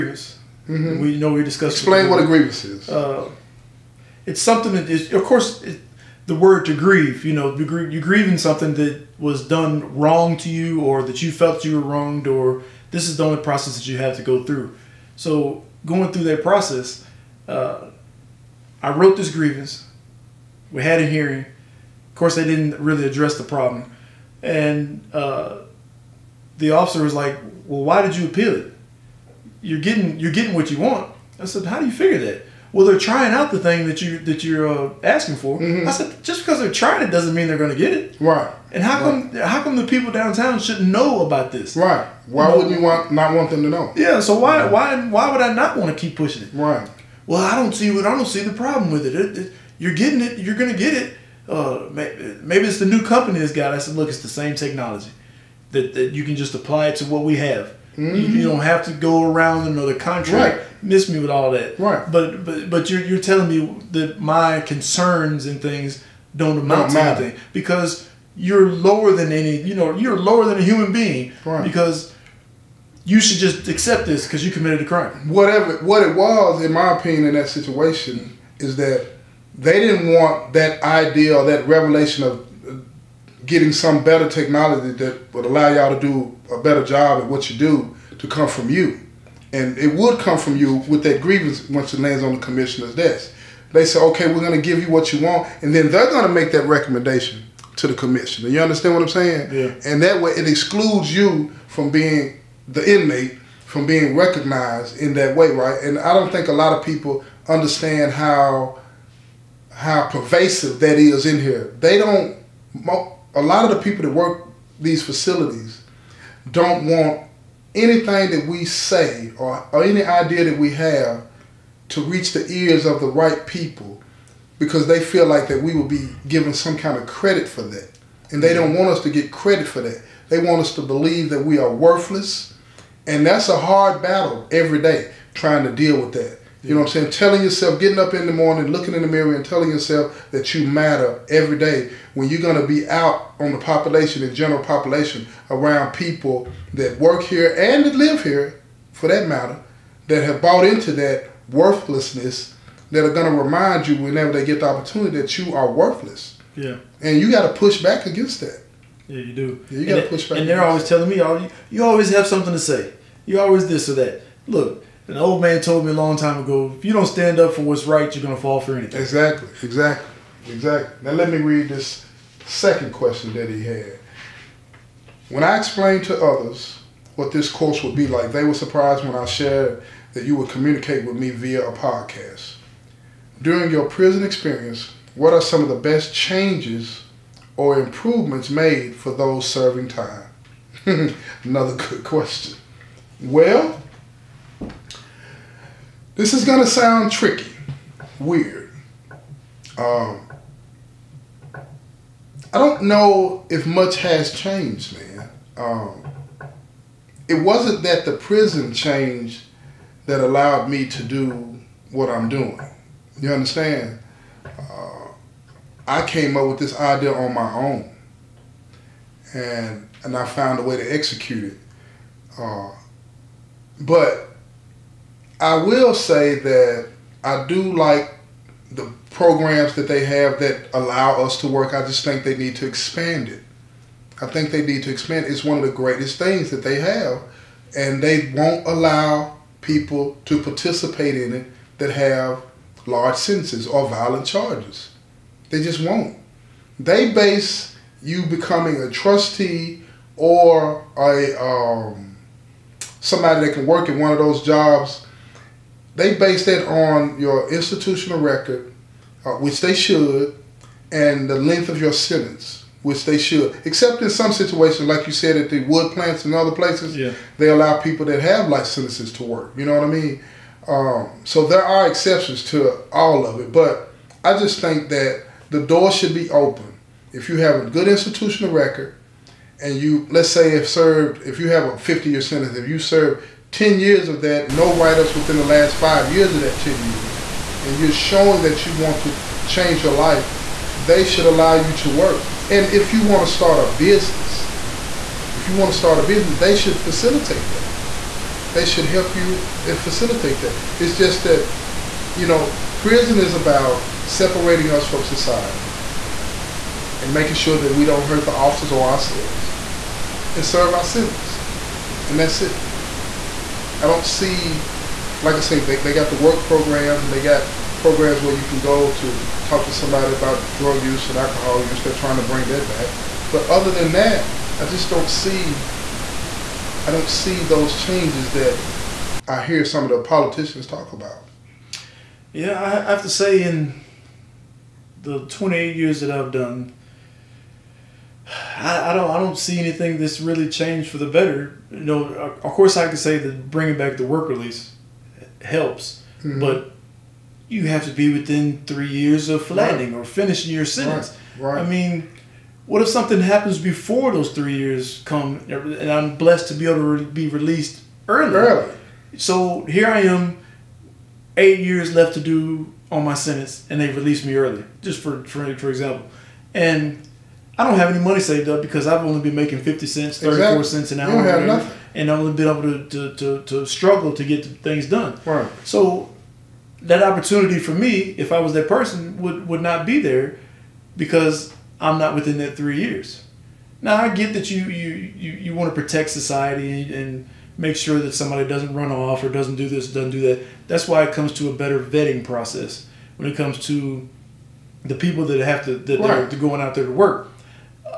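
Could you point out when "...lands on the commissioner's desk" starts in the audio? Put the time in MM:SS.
01:31.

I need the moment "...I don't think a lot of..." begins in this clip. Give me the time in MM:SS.
01:45.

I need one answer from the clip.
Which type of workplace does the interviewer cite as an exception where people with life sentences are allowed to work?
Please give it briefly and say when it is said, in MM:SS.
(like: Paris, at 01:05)
Wood plants, at 04:25.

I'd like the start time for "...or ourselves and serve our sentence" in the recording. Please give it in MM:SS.
05:08.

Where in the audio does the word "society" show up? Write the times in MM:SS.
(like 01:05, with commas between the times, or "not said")
05:05, 06:26.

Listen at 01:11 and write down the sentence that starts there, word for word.
because you should just accept this because you committed a crime.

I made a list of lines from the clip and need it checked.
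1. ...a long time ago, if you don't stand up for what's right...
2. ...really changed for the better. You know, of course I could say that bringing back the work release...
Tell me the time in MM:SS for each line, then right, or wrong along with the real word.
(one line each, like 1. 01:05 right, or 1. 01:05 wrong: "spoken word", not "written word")
1. 02:45 right
2. 05:40 right.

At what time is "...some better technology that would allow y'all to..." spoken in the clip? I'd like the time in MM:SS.
01:23.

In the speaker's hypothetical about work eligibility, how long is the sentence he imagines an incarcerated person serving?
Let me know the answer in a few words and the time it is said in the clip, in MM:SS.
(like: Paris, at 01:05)
50 years, at 04:41.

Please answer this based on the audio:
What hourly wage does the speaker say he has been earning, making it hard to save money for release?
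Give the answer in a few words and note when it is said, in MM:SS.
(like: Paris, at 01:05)
50 cents, at 06:09.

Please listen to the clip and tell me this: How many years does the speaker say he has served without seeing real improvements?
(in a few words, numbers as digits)
28.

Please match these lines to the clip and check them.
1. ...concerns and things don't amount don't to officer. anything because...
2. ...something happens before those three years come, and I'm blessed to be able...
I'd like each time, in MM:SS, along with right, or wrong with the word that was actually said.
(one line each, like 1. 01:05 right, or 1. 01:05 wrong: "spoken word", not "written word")
1. 01:04 wrong: "matter", not "officer"
2. 05:52 right.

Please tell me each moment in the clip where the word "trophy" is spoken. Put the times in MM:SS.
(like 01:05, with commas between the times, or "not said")
not said.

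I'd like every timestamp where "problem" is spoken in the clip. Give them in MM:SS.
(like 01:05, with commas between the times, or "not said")
00:23, 00:48.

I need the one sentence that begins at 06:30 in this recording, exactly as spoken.
That's why it comes to a better vetting process when it comes to the people that have to, that, right.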